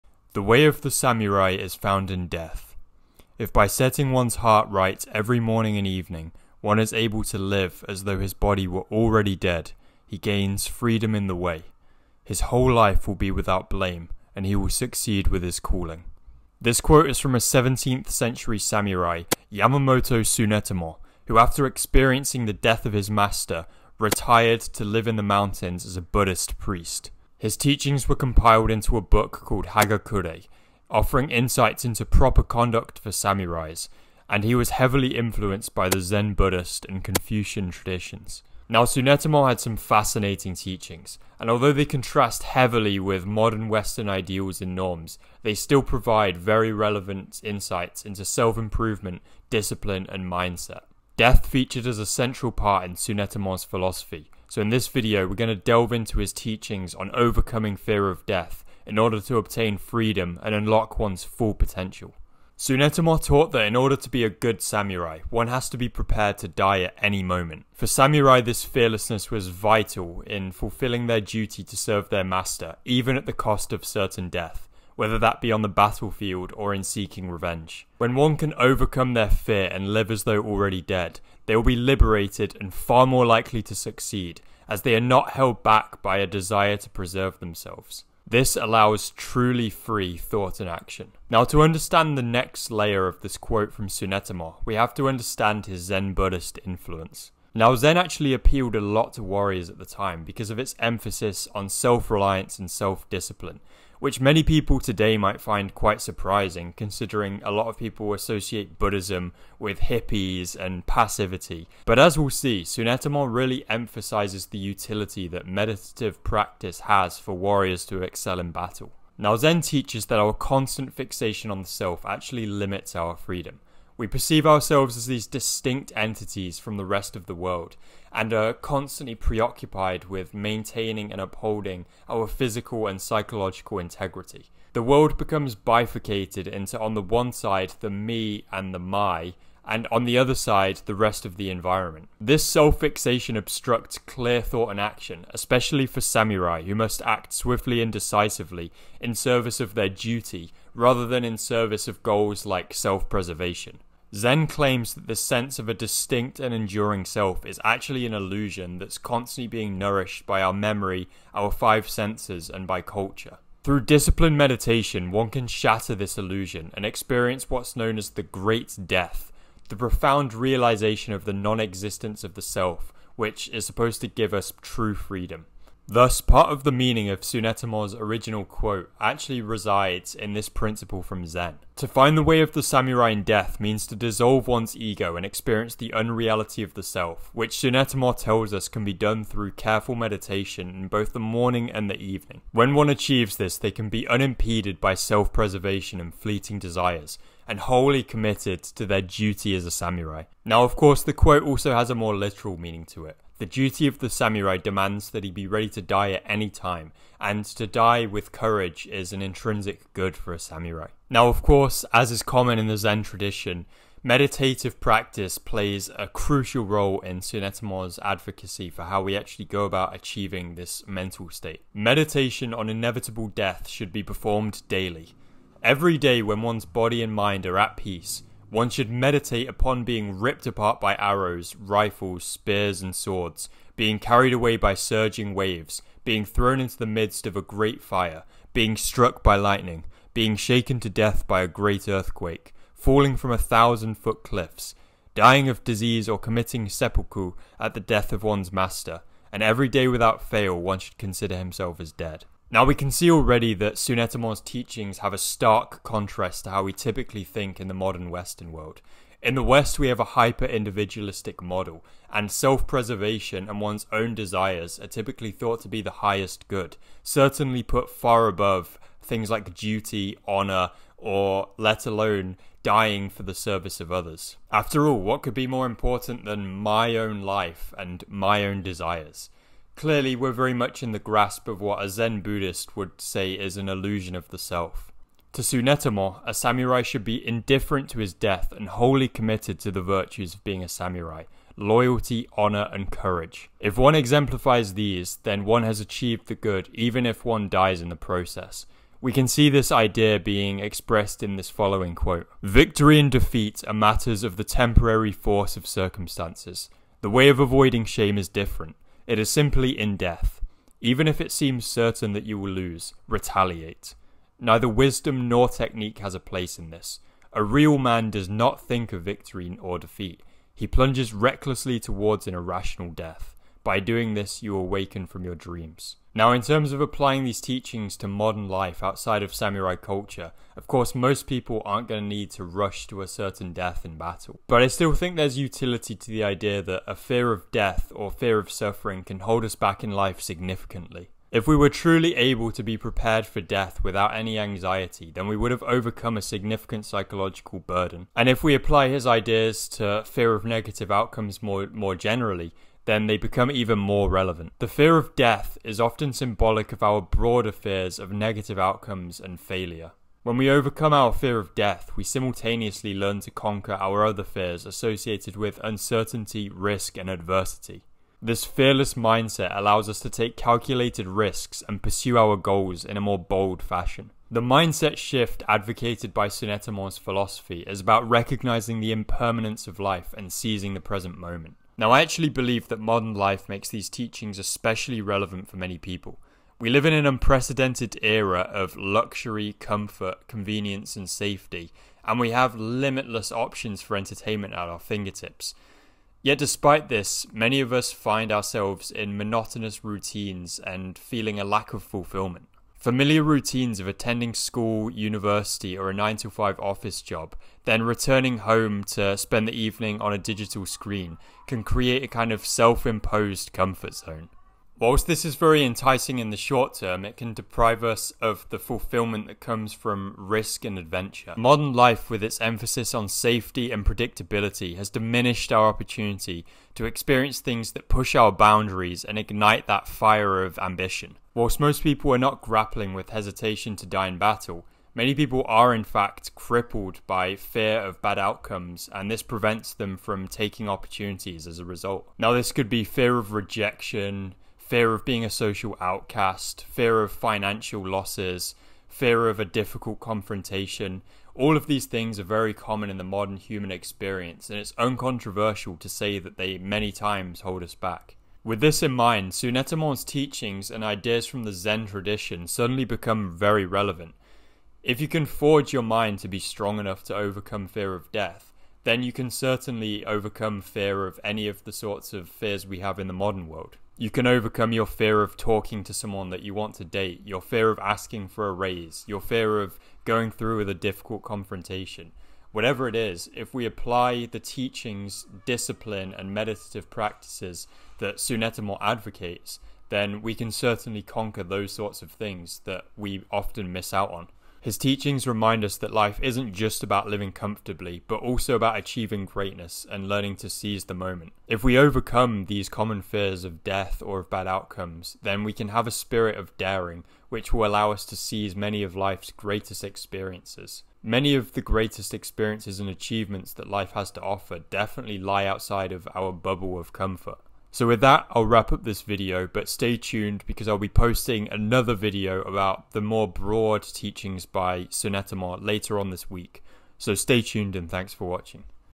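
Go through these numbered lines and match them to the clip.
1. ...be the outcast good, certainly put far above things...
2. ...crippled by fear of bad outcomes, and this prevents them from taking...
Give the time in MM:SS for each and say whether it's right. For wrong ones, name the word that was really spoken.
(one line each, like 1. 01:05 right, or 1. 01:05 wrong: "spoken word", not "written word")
1. 04:25 wrong: "highest", not "outcast"
2. 07:16 right.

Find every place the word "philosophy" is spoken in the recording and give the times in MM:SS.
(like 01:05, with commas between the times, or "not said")
00:53, 06:16.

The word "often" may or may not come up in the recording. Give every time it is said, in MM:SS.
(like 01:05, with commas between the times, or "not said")
05:55, 08:13.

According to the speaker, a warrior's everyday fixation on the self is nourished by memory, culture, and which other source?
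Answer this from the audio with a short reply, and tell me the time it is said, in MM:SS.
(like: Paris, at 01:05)
our five senses, at 02:41.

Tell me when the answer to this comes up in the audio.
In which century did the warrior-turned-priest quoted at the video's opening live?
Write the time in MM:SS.
00:17.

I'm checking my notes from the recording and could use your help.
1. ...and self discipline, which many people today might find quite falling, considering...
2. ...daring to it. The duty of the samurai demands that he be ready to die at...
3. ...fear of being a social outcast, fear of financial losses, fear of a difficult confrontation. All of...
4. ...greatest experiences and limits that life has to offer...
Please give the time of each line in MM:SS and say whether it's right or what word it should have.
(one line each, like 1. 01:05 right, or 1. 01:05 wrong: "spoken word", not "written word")
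1. 01:42 wrong: "surprising", not "falling"
2. 03:22 wrong: "meaning", not "daring"
3. 07:24 right
4. 08:31 wrong: "achievements", not "limits".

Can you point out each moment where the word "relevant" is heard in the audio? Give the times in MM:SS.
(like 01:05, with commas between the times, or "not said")
00:46, 05:54, 06:25, 07:43.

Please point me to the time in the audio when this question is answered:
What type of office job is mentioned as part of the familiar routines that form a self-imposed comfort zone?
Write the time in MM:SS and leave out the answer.
06:45.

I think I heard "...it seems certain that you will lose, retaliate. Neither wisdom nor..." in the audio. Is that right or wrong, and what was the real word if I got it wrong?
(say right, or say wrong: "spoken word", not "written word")
right.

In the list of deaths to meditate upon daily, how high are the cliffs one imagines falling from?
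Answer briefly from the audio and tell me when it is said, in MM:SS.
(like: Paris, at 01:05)
1,000 feet, at 04:03.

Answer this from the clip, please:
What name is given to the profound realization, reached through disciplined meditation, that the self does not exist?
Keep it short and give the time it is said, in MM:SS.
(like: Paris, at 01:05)
the Great Death, at 02:48.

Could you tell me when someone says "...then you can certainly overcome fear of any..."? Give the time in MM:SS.
07:48.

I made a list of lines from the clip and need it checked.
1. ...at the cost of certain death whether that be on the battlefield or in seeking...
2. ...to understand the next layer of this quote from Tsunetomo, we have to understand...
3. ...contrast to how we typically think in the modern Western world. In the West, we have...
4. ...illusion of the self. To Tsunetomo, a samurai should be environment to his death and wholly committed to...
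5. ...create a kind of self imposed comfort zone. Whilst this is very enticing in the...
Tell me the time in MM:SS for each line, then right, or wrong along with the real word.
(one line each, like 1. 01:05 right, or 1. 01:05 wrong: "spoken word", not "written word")
1. 01:13 right
2. 01:31 right
3. 04:15 right
4. 04:43 wrong: "indifferent", not "environment"
5. 06:51 right.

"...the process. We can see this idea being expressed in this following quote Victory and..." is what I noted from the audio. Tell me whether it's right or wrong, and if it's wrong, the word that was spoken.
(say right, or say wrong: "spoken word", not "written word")
right.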